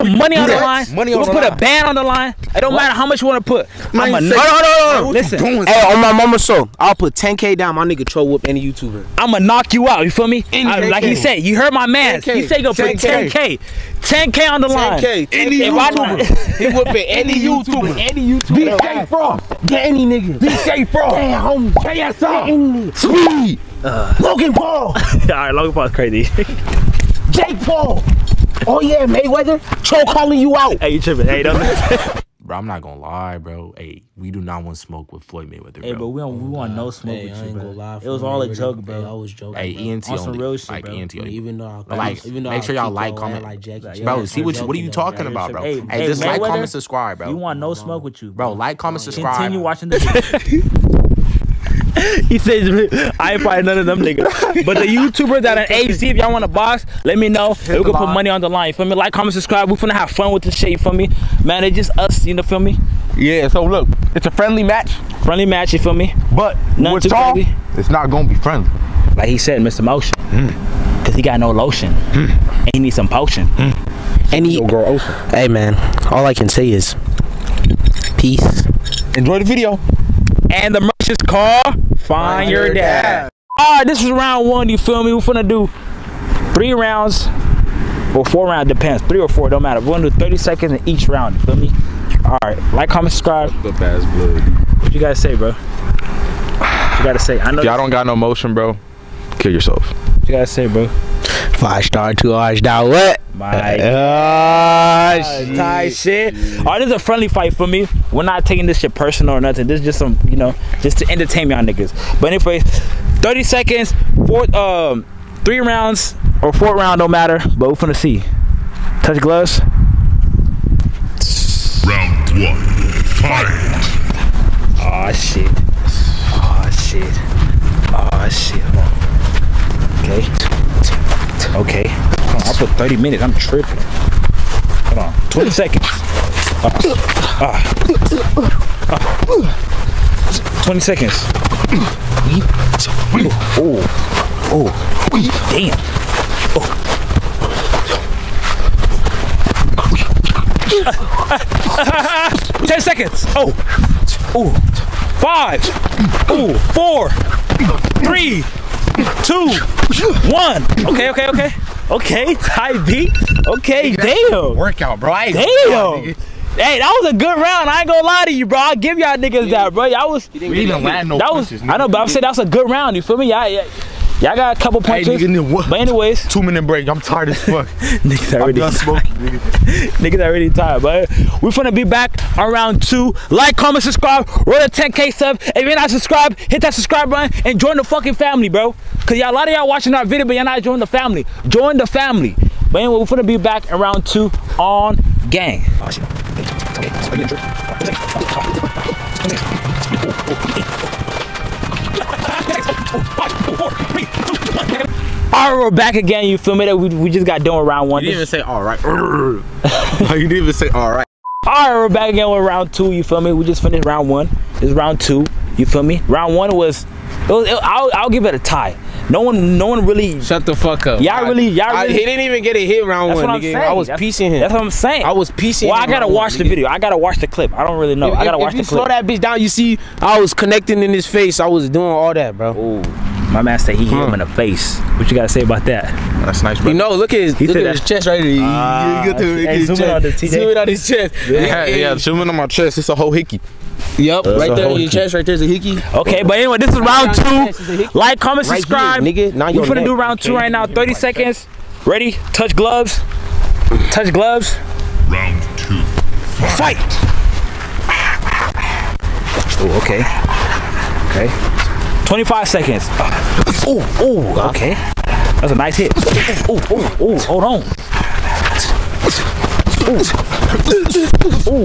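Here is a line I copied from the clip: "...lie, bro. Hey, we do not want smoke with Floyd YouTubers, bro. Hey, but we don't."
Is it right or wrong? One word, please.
wrong.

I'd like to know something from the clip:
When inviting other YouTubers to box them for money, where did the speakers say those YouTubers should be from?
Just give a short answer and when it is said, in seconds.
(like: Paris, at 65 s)
AZ, at 55 s.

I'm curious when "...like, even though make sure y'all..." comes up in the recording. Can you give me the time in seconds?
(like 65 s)
41 s.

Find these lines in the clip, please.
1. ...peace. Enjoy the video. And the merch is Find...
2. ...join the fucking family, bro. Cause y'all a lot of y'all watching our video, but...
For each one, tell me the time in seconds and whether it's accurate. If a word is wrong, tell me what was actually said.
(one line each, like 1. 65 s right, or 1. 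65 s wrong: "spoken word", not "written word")
1. 78 s right
2. 187 s right.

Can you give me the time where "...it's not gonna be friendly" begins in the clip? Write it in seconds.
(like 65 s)
67 s.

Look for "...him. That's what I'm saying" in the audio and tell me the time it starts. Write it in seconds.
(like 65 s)
224 s.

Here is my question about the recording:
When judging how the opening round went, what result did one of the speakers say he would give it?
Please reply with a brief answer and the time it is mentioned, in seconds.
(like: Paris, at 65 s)
A tie, at 218 s.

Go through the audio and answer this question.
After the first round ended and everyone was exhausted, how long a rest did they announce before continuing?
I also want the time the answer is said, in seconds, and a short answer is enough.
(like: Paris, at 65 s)
2 minutes, at 176 s.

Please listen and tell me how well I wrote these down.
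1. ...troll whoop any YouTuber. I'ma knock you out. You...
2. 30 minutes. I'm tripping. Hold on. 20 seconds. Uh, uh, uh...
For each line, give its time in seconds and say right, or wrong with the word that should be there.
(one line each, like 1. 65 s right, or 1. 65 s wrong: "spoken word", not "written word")
1. 8 s right
2. 132 s right.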